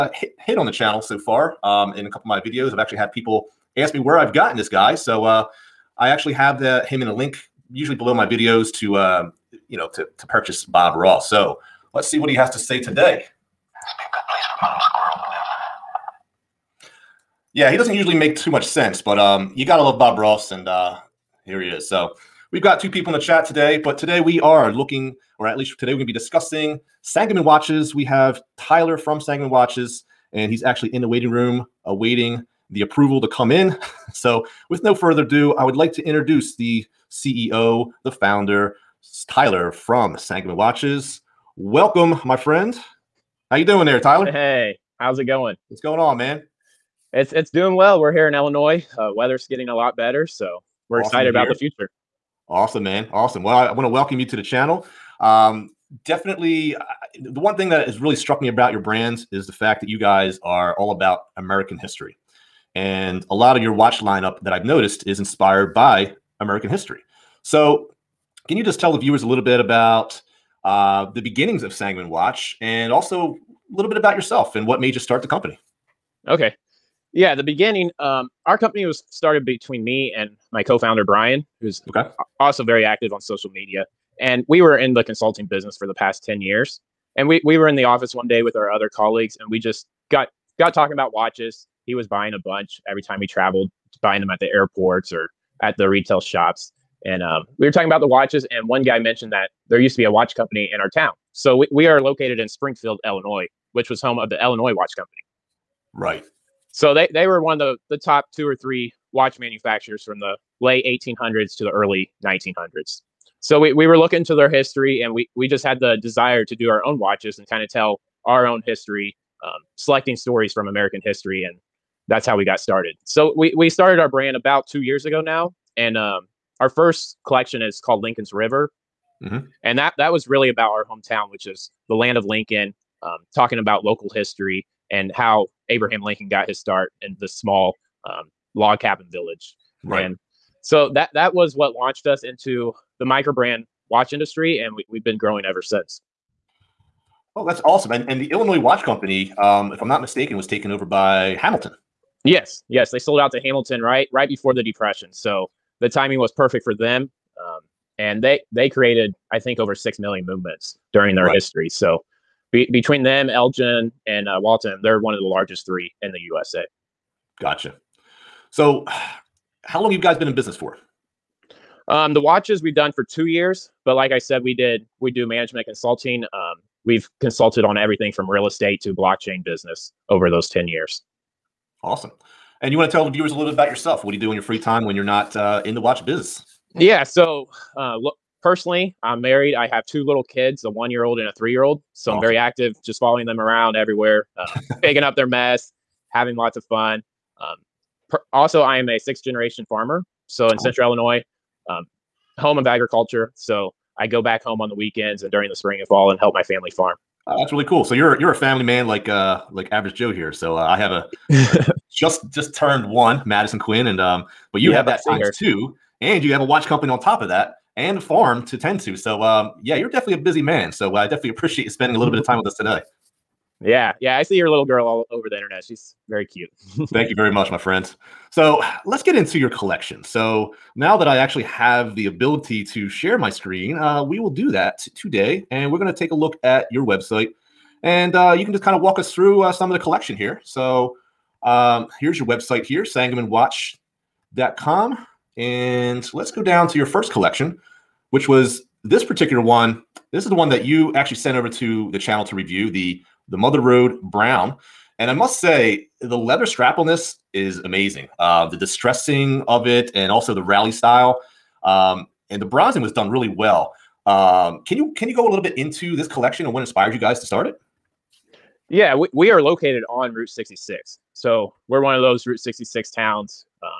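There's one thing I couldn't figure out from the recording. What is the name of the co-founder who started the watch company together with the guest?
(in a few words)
Brian.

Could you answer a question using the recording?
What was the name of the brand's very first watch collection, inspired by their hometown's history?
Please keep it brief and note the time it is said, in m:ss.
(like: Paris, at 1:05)
Lincoln's River, at 2:08.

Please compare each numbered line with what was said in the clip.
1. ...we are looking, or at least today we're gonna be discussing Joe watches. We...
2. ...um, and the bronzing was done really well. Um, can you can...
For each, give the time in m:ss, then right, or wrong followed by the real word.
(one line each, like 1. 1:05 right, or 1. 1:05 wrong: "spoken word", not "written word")
1. 0:24 wrong: "Sangamon", not "Joe"
2. 4:21 right.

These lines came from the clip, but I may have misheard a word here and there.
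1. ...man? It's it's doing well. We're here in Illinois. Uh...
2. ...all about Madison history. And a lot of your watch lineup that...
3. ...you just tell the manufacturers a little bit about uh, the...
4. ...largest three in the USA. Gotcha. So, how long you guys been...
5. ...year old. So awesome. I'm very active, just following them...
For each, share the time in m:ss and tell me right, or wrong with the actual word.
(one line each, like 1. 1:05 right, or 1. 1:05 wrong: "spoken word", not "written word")
1. 0:46 right
2. 1:00 wrong: "American", not "Madison"
3. 1:08 wrong: "viewers", not "manufacturers"
4. 2:45 right
5. 3:11 right.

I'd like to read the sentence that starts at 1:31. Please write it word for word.
He was buying a bunch every time we traveled, buying them at the airports or at the retail shops.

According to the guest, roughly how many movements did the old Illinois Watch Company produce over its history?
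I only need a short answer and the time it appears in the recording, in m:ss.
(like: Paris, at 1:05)
over 6 million, at 2:39.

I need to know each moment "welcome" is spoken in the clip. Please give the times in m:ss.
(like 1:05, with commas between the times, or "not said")
0:41, 0:53.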